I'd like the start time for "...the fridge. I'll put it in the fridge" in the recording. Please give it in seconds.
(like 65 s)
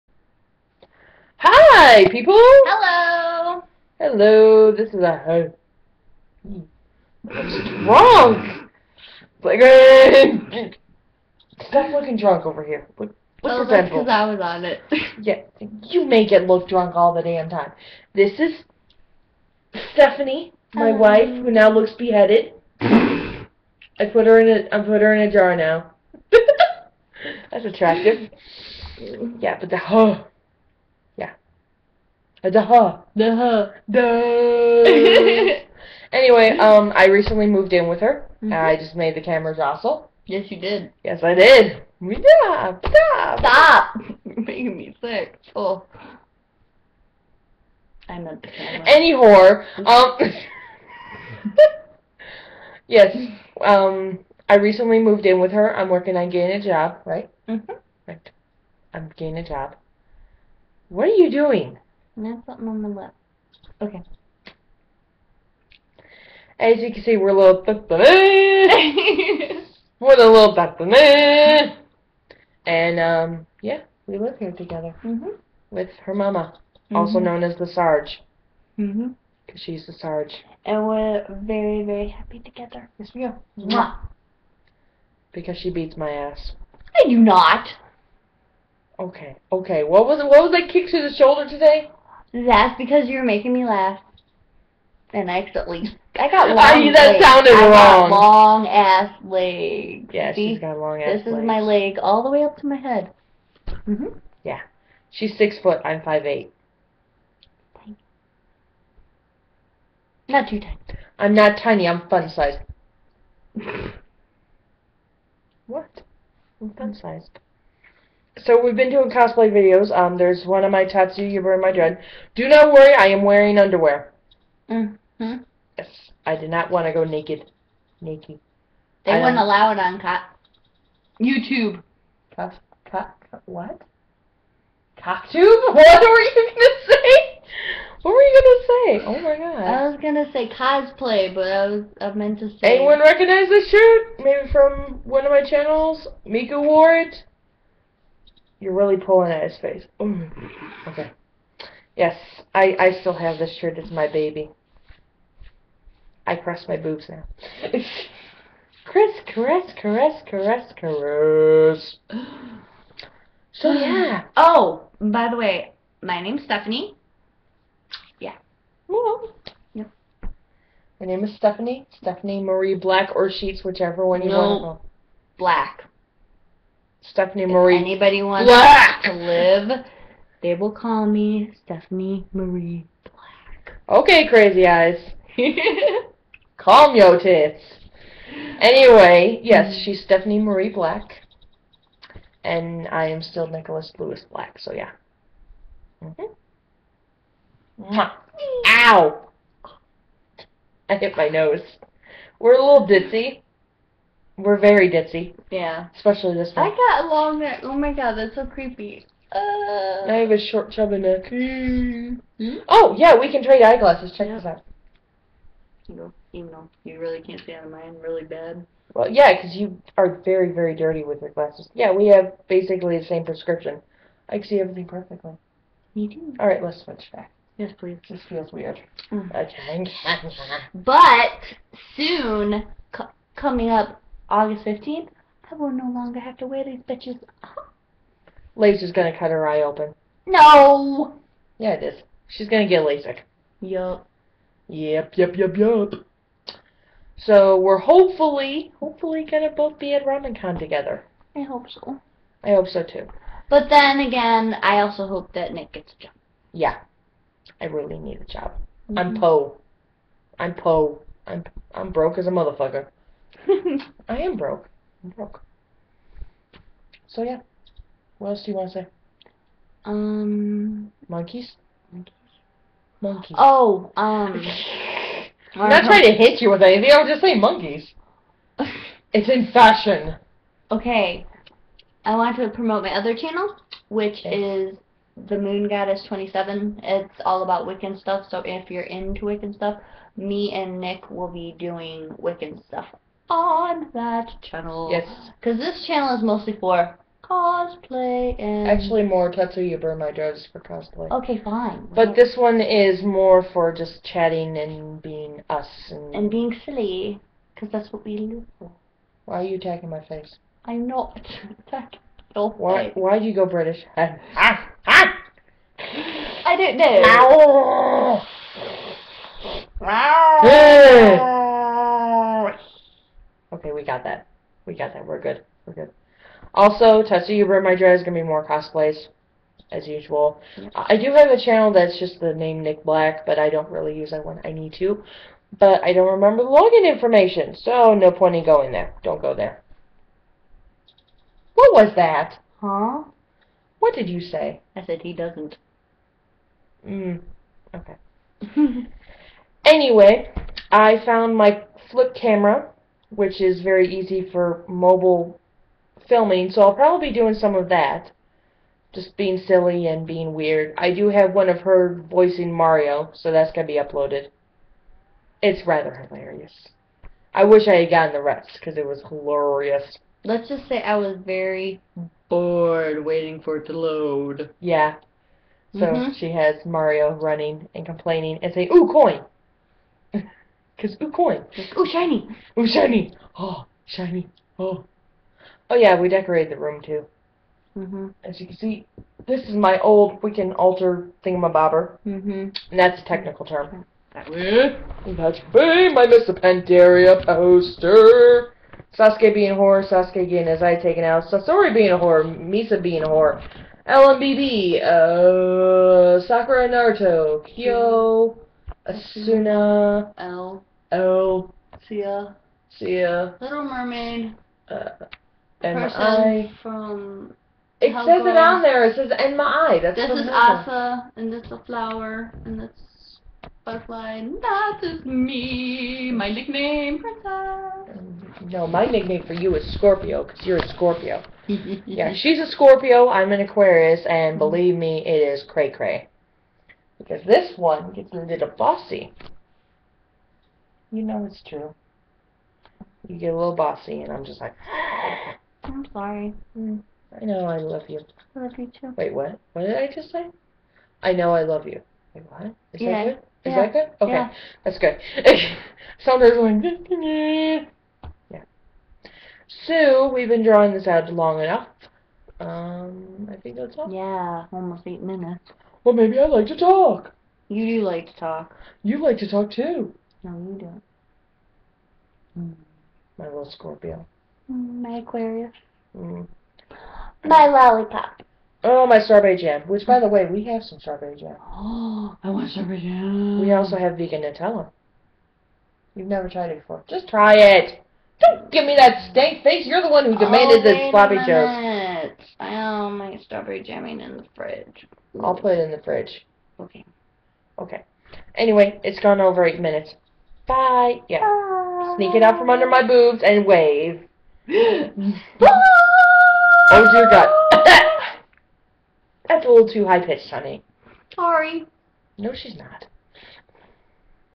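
494 s.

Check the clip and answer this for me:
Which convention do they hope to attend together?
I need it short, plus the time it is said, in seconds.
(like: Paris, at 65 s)
RamenCon, at 250 s.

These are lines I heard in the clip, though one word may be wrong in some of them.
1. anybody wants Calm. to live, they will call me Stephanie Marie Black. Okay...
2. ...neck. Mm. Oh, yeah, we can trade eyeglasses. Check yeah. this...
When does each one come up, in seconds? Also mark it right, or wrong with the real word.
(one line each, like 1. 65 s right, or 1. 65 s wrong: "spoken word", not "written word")
1. 177 s wrong: "Black", not "Calm"
2. 210 s right.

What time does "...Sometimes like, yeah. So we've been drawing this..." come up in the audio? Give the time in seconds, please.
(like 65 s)
455 s.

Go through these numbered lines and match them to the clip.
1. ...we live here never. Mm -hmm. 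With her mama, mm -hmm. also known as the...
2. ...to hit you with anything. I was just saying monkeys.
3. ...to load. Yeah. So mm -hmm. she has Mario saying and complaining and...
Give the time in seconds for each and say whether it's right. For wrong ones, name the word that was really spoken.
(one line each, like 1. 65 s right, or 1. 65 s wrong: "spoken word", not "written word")
1. 74 s wrong: "together", not "never"
2. 276 s right
3. 373 s wrong: "running", not "saying".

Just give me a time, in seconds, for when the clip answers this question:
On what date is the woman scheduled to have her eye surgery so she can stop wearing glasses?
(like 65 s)
234 s.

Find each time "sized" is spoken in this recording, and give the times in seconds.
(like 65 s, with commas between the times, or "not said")
112 s, 116 s.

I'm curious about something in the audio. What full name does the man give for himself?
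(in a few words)
Nicholas Lewis Black.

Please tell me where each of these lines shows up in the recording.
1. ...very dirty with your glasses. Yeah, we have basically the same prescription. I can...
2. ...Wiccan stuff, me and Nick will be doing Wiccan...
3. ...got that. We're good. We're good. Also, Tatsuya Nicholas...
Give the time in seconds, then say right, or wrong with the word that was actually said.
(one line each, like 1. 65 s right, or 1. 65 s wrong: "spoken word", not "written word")
1. 220 s right
2. 289 s right
3. 324 s wrong: "Burn", not "Nicholas".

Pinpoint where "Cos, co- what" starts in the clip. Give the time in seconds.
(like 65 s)
132 s.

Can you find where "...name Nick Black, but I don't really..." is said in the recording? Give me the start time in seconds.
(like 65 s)
332 s.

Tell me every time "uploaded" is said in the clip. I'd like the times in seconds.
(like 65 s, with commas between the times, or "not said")
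363 s.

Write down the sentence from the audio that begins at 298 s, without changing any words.
Actually, more Tatsuya My drives for cosplay.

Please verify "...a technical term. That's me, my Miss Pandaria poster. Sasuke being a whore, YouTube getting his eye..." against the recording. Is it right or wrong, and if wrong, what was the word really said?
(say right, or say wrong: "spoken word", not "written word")
wrong: "Sasuke", not "YouTube".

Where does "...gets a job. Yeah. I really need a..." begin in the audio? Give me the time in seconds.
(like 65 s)
255 s.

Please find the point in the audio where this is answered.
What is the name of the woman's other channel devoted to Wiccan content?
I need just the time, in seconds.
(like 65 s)
285 s.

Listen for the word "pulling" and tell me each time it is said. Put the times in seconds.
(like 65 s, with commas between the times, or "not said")
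148 s.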